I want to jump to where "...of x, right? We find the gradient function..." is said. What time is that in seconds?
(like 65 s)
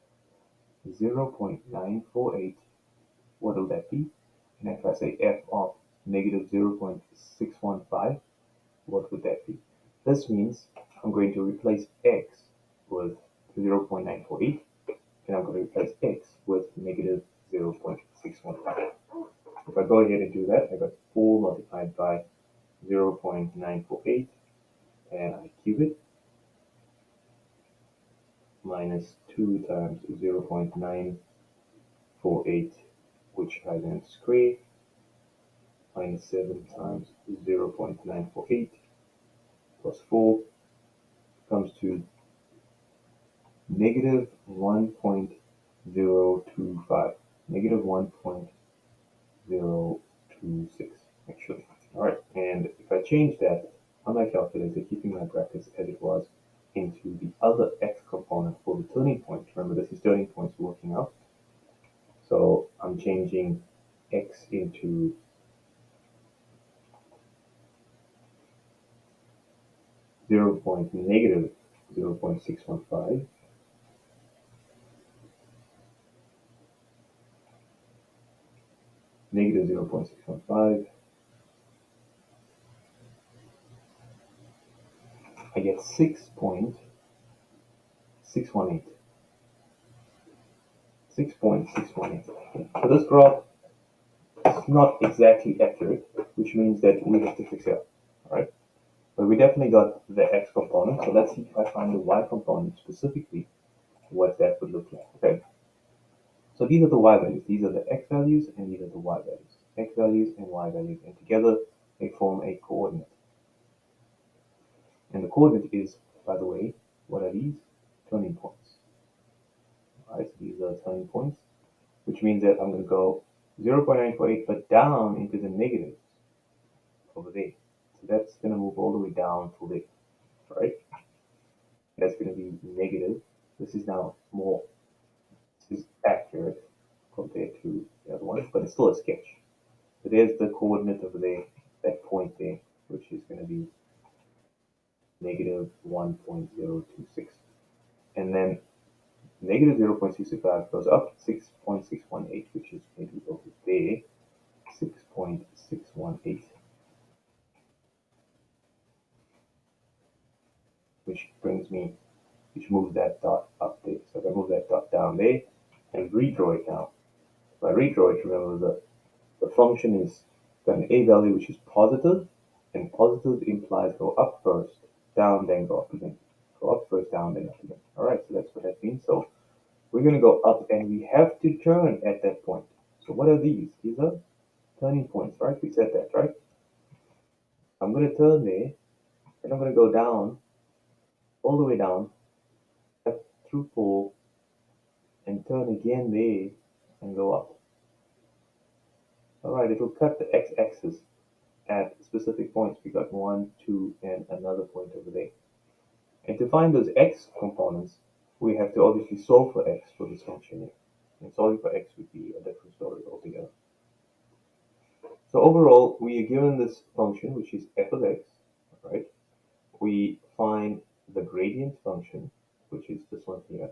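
217 s.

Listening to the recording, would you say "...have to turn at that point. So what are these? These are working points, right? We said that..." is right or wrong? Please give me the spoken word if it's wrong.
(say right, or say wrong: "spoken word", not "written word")
wrong: "turning", not "working".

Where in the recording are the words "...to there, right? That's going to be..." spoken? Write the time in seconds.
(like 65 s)
129 s.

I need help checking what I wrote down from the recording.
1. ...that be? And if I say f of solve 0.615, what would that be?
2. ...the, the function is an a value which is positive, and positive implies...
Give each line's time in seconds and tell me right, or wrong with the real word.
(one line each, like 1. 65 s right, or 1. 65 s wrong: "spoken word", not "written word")
1. 3 s wrong: "negative", not "solve"
2. 168 s right.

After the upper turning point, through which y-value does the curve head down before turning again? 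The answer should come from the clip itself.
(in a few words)
4.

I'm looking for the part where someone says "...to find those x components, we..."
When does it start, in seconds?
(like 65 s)
206 s.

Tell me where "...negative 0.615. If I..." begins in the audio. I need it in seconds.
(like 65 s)
16 s.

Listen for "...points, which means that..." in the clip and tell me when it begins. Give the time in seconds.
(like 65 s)
121 s.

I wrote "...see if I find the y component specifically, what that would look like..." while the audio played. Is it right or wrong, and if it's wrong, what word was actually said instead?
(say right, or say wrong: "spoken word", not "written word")
right.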